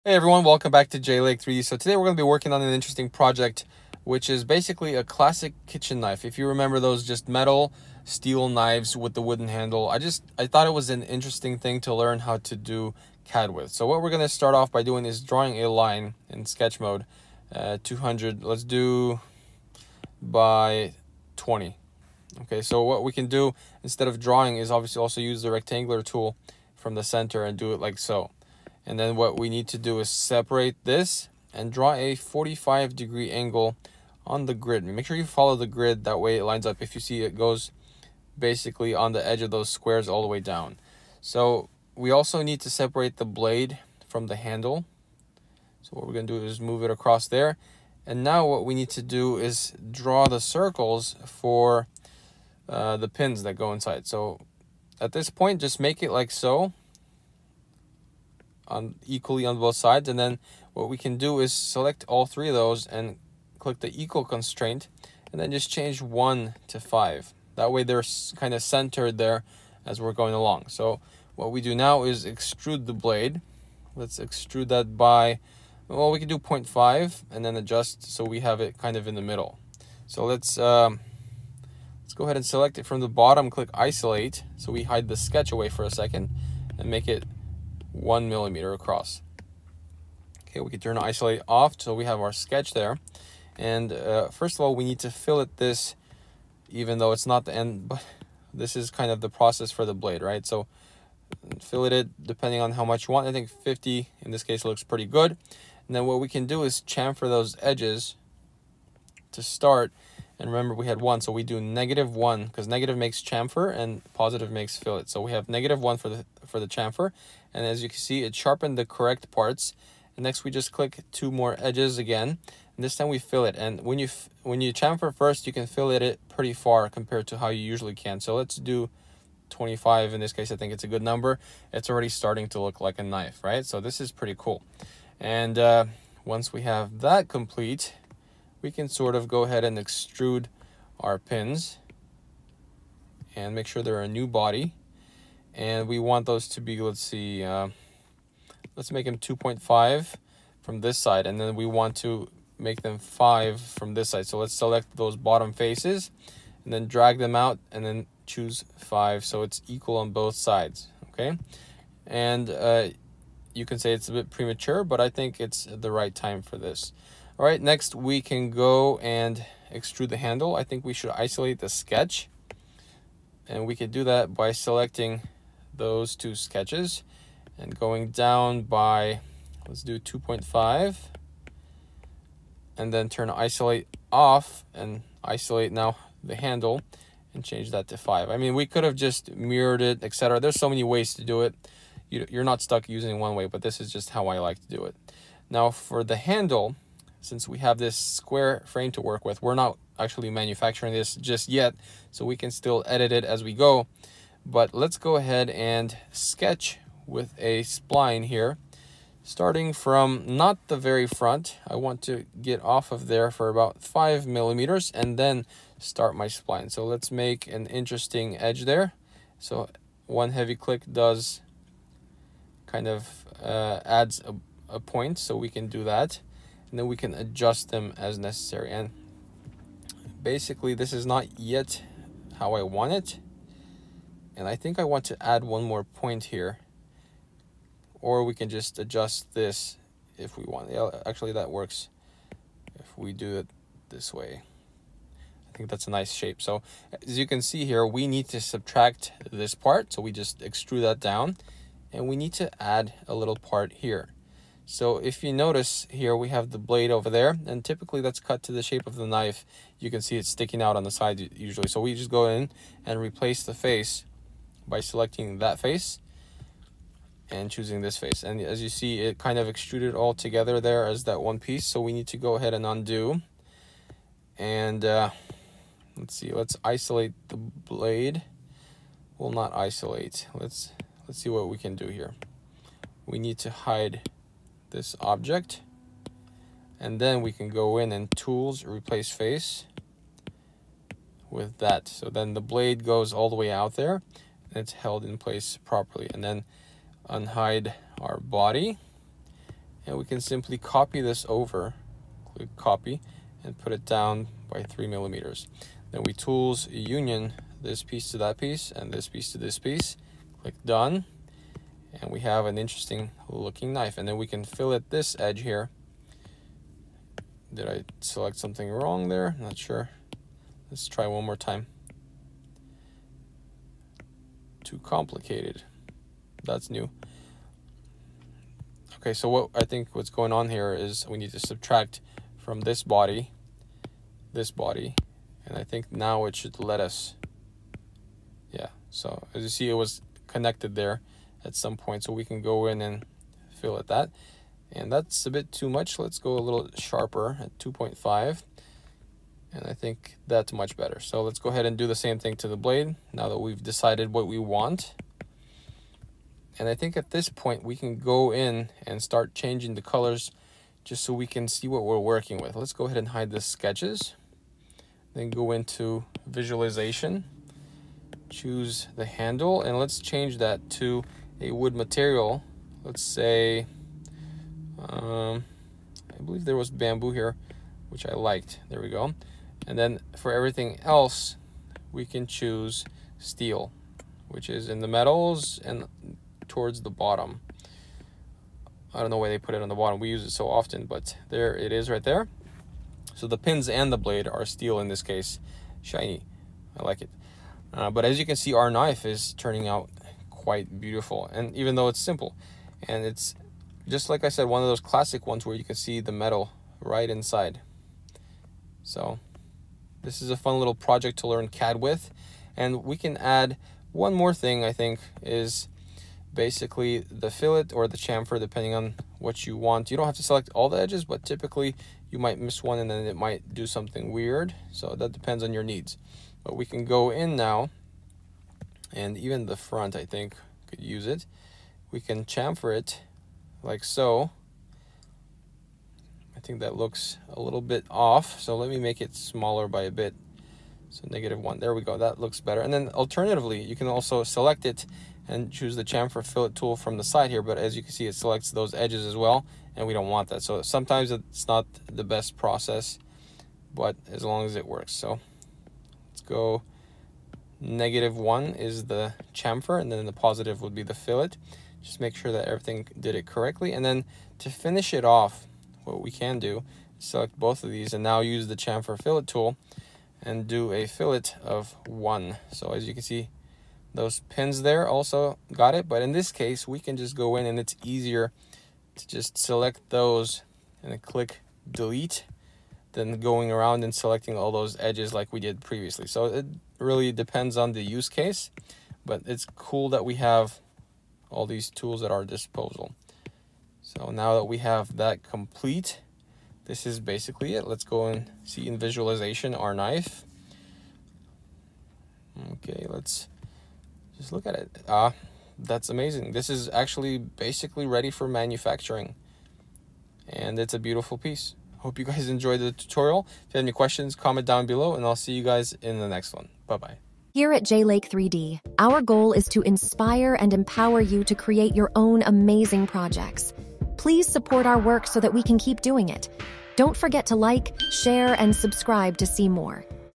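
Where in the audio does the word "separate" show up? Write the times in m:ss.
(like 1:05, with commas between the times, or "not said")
0:30, 0:42.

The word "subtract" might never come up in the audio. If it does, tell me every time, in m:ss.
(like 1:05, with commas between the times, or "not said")
4:08, 5:31.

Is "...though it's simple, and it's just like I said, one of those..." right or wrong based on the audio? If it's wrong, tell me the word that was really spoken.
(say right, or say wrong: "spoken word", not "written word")
right.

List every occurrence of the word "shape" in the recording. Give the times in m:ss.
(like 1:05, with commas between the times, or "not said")
4:06, 4:18.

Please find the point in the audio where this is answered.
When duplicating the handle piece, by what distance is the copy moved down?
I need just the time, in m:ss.
5:04.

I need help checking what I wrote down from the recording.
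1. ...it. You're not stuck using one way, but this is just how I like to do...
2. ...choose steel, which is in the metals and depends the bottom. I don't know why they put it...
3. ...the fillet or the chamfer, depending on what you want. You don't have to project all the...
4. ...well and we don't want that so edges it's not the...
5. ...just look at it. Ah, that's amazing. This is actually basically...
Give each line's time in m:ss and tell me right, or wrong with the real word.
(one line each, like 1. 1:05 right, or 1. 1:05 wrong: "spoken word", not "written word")
1. 3:11 right
2. 6:22 wrong: "towards", not "depends"
3. 6:57 wrong: "select", not "project"
4. 7:29 wrong: "sometimes", not "edges"
5. 8:24 right.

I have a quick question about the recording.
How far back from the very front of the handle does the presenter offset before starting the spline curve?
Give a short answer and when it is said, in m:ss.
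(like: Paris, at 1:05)
5 millimeters, at 3:33.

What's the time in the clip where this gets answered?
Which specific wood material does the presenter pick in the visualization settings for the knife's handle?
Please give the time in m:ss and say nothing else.
6:16.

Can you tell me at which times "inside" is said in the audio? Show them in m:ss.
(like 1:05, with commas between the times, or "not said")
0:53, 6:47.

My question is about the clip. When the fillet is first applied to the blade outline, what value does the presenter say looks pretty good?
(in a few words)
50.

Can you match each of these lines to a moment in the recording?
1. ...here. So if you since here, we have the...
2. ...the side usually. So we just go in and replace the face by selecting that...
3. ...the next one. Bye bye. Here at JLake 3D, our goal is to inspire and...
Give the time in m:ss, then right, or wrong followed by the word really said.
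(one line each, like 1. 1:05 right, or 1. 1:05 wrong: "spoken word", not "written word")
1. 4:13 wrong: "notice", not "since"
2. 4:20 right
3. 8:35 right.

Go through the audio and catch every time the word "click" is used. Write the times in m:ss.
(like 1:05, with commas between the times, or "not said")
1:03, 1:23, 2:00, 3:40, 5:02, 5:10, 8:01.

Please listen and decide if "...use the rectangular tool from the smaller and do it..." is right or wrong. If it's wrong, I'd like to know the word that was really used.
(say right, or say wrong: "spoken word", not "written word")
wrong: "center", not "smaller".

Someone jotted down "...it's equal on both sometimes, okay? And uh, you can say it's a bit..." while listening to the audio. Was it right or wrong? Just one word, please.
wrong.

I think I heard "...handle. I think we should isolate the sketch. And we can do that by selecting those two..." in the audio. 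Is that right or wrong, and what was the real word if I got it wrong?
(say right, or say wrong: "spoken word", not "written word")
right.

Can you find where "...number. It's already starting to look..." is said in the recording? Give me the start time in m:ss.
2:11.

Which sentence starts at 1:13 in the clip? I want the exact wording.
Let's extrude that by, well, we can do 0.5 and then adjust so we have it kind of in the middle.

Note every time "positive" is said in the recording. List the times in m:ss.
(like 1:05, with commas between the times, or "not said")
1:54, 7:40.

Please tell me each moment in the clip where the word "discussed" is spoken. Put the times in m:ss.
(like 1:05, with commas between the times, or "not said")
not said.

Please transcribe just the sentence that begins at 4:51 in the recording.
So then the blade goes all the way out there and it's held in place properly.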